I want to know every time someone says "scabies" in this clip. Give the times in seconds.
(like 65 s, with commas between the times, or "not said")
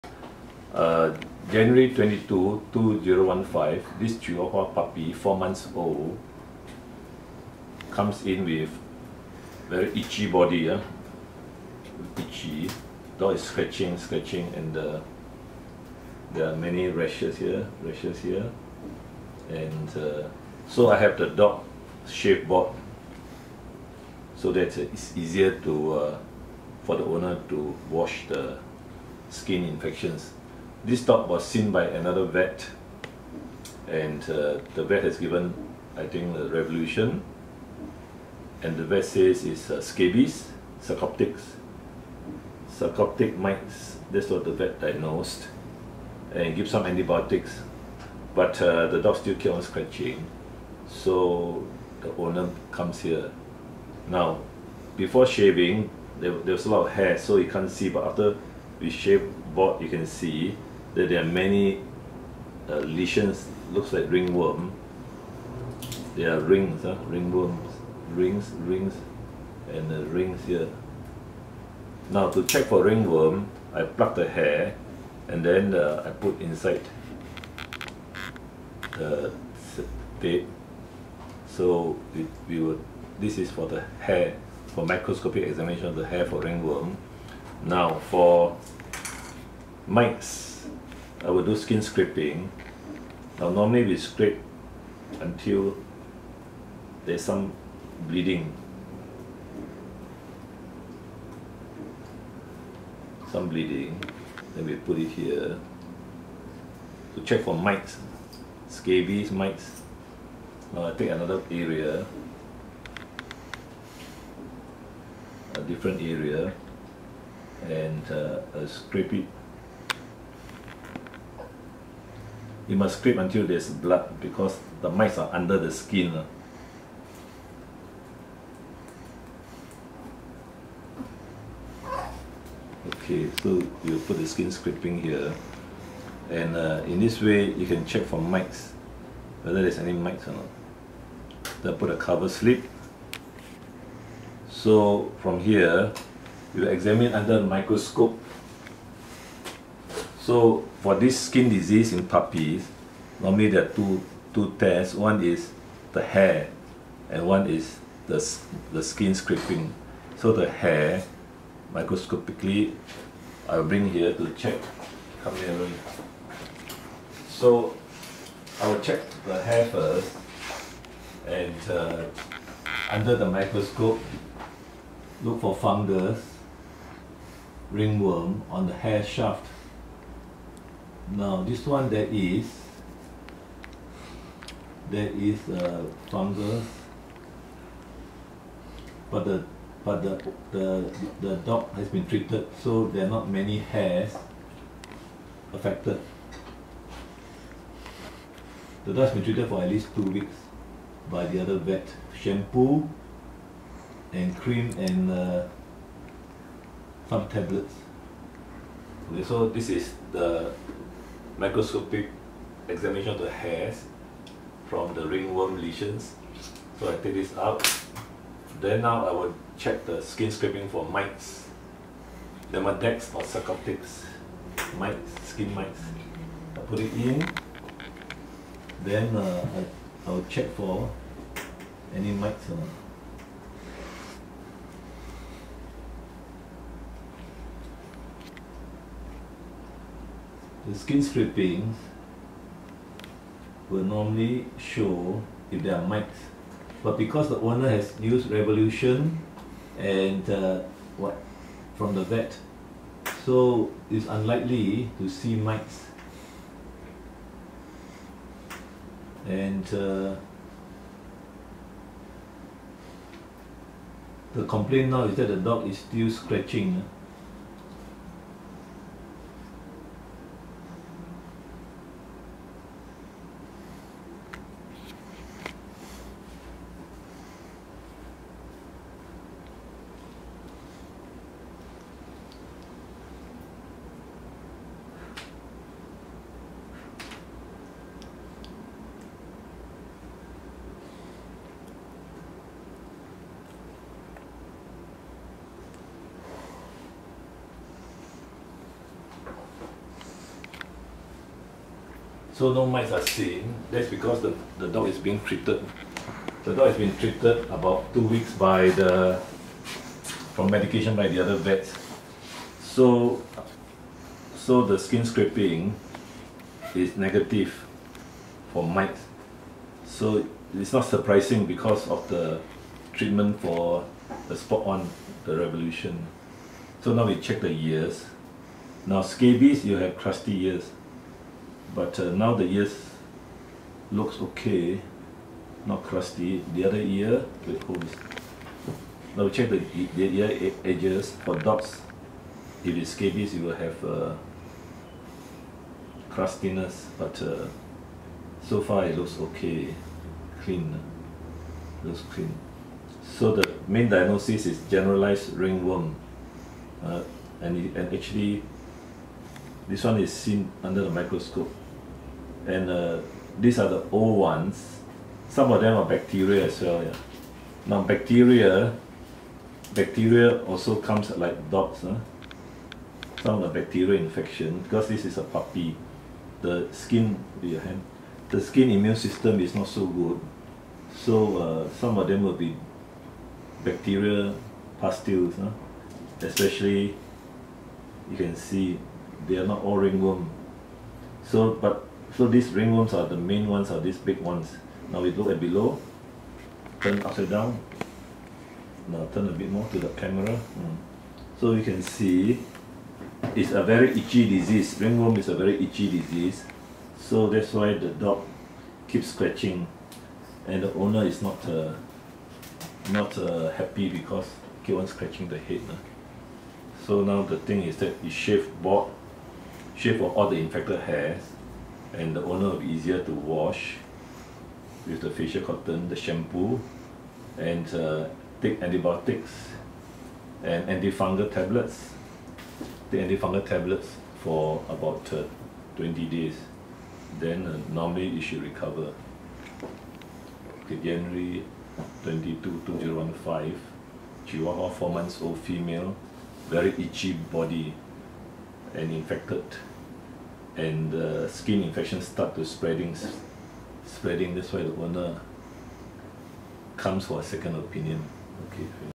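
39 s, 108 s, 329 s, 342 s.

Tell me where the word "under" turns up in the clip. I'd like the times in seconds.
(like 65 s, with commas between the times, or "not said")
125 s, 147 s, 172 s, 360 s.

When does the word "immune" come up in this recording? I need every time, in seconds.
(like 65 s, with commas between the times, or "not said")
378 s.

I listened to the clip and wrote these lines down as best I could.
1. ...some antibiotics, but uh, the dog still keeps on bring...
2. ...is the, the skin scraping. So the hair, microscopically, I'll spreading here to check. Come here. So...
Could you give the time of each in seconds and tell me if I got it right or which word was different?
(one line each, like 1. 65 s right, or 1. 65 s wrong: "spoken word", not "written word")
1. 46 s wrong: "scratching", not "bring"
2. 157 s wrong: "bring", not "spreading".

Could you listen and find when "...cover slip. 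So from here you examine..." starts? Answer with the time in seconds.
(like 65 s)
141 s.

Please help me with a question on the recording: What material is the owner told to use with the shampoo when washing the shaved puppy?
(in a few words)
Facial cotton.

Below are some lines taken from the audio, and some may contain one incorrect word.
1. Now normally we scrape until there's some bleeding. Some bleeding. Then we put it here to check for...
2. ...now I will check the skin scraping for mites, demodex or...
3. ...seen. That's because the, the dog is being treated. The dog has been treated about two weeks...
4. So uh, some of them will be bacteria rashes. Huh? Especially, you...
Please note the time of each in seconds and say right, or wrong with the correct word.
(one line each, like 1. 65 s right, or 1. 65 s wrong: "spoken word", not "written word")
1. 93 s right
2. 218 s right
3. 303 s right
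4. 380 s wrong: "pustules", not "rashes".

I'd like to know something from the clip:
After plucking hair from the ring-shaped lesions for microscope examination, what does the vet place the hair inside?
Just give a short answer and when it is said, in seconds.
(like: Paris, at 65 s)
Tape, at 80 s.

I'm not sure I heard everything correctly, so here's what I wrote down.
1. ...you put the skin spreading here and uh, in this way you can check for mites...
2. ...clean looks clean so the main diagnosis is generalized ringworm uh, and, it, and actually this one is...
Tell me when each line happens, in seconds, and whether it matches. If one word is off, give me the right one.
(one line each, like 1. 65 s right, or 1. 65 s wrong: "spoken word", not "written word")
1. 133 s wrong: "scraping", not "spreading"
2. 350 s right.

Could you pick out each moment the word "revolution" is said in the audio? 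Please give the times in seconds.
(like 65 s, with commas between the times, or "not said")
36 s, 248 s, 325 s.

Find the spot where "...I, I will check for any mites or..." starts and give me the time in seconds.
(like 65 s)
229 s.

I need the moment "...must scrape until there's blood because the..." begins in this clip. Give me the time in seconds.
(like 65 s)
122 s.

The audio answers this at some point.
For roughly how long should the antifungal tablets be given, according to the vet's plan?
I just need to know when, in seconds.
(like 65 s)
435 s.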